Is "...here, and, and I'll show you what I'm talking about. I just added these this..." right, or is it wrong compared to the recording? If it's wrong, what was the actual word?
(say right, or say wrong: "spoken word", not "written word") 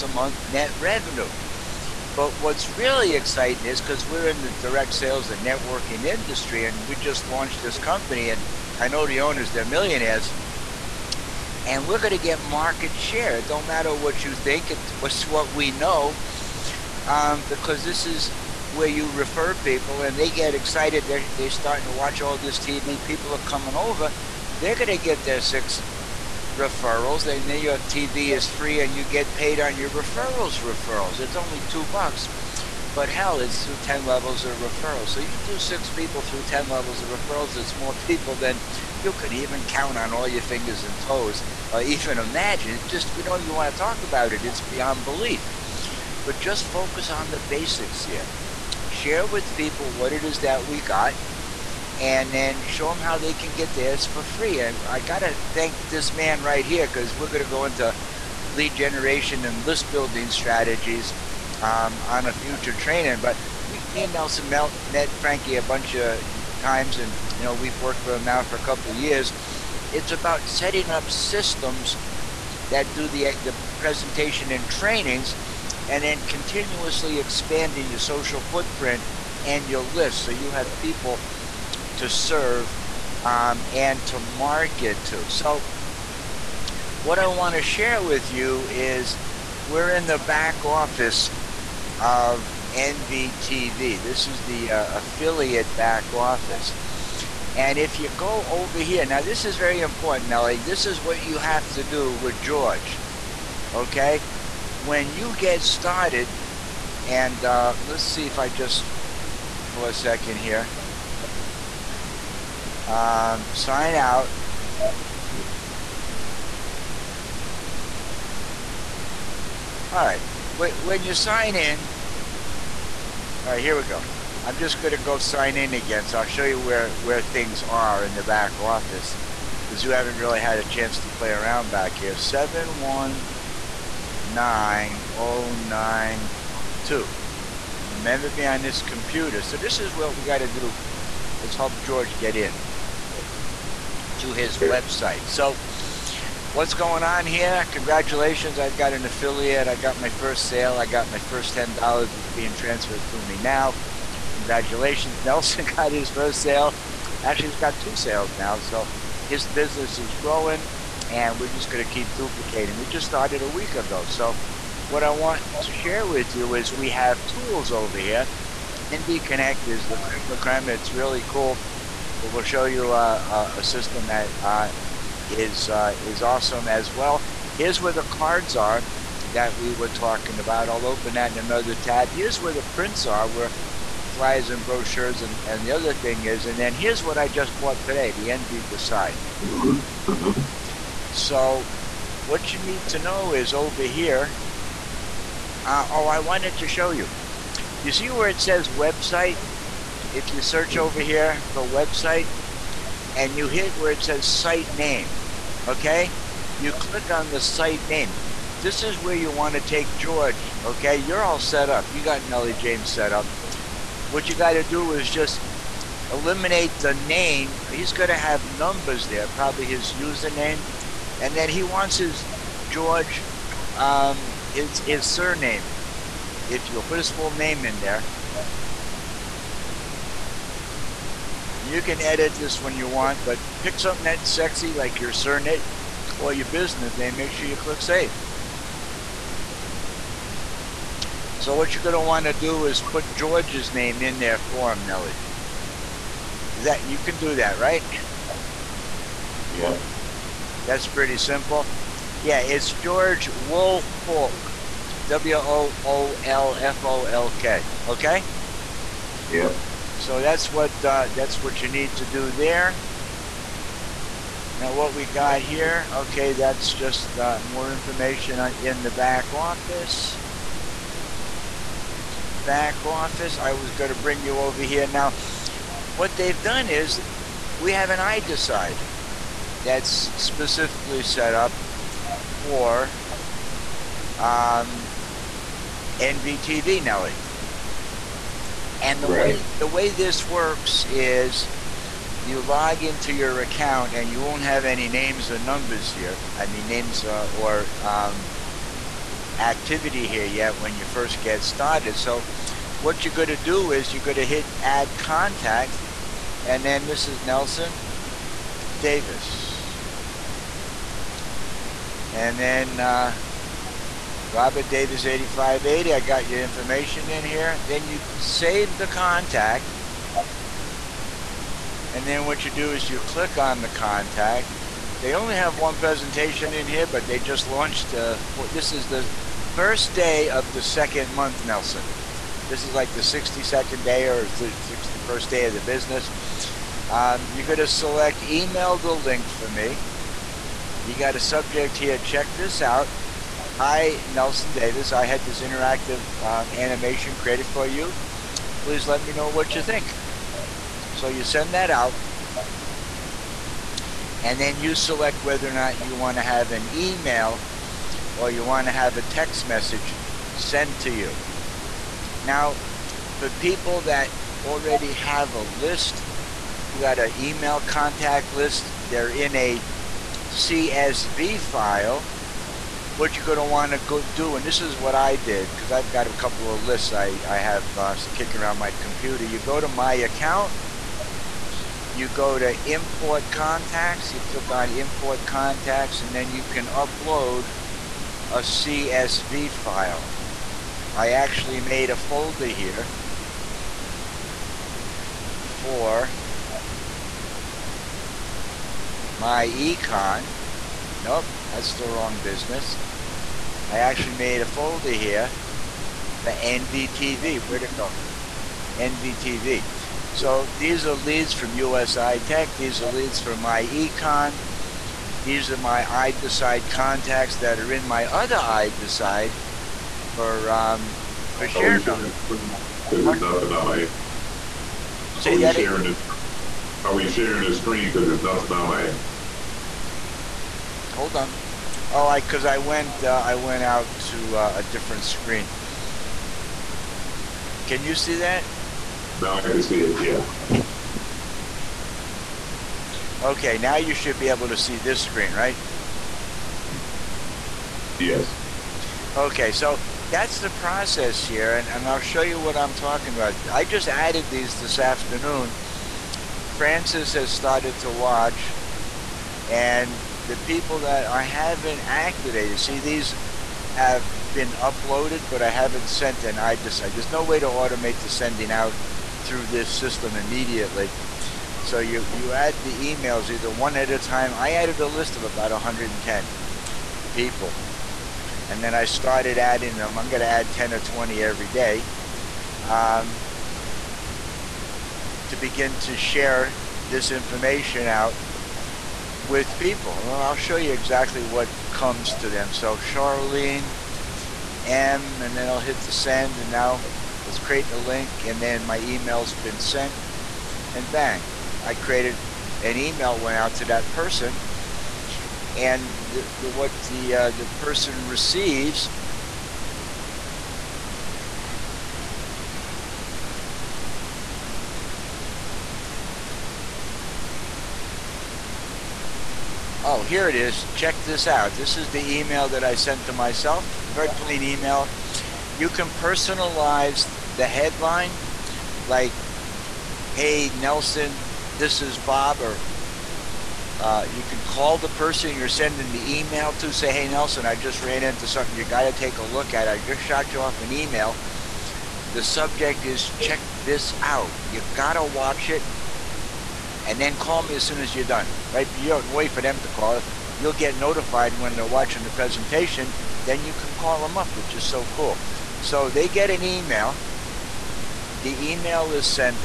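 right.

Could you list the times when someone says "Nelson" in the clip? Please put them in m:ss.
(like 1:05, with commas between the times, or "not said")
1:04, 2:35, 5:07, 5:31, 5:44, 8:50, 8:57.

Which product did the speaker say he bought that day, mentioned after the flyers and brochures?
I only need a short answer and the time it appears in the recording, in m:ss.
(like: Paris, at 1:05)
NV Decide, at 3:08.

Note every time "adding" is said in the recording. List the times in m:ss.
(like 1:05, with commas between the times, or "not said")
7:59.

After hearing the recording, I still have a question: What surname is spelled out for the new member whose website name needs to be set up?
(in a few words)
Woolfolk.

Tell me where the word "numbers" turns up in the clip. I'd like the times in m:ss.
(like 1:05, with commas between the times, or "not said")
3:38, 4:55.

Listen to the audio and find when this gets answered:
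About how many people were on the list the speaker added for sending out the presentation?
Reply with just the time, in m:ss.
7:55.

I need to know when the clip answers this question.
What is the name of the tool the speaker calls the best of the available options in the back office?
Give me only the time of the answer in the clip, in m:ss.
2:48.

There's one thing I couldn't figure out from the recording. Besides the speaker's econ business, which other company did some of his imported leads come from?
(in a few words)
USI Tech.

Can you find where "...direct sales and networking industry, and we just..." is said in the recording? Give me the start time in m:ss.
0:04.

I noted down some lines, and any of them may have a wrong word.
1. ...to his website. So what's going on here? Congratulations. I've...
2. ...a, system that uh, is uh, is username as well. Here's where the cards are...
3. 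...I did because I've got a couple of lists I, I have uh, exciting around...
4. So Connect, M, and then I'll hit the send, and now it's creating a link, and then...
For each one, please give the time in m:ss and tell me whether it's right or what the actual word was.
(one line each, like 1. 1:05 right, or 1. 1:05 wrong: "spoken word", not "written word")
1. 2:24 right
2. 2:53 wrong: "awesome", not "username"
3. 6:14 wrong: "kicking", not "exciting"
4. 8:12 wrong: "Charlene", not "Connect".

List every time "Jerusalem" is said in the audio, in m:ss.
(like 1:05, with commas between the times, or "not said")
not said.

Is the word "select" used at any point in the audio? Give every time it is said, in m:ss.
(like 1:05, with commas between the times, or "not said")
5:37, 5:54.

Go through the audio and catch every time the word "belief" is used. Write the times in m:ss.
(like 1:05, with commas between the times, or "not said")
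0:45.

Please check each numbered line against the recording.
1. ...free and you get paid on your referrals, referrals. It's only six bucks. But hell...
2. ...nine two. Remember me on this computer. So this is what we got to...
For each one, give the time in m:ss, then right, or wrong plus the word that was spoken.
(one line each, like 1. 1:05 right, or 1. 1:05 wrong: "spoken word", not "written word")
1. 0:28 wrong: "two", not "six"
2. 2:15 right.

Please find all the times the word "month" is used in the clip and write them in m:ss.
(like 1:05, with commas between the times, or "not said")
0:00, 5:31.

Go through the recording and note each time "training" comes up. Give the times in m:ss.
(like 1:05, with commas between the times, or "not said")
1:02, 1:14.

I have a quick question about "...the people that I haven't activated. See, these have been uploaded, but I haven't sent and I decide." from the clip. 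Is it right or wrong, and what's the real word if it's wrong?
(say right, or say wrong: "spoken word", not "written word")
right.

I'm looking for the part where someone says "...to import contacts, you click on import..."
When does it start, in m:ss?
6:22.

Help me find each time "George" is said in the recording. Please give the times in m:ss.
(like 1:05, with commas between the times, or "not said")
1:42, 2:21, 3:29, 3:42, 4:03, 4:12.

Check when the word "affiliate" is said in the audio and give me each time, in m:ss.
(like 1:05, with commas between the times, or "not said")
1:34, 2:29.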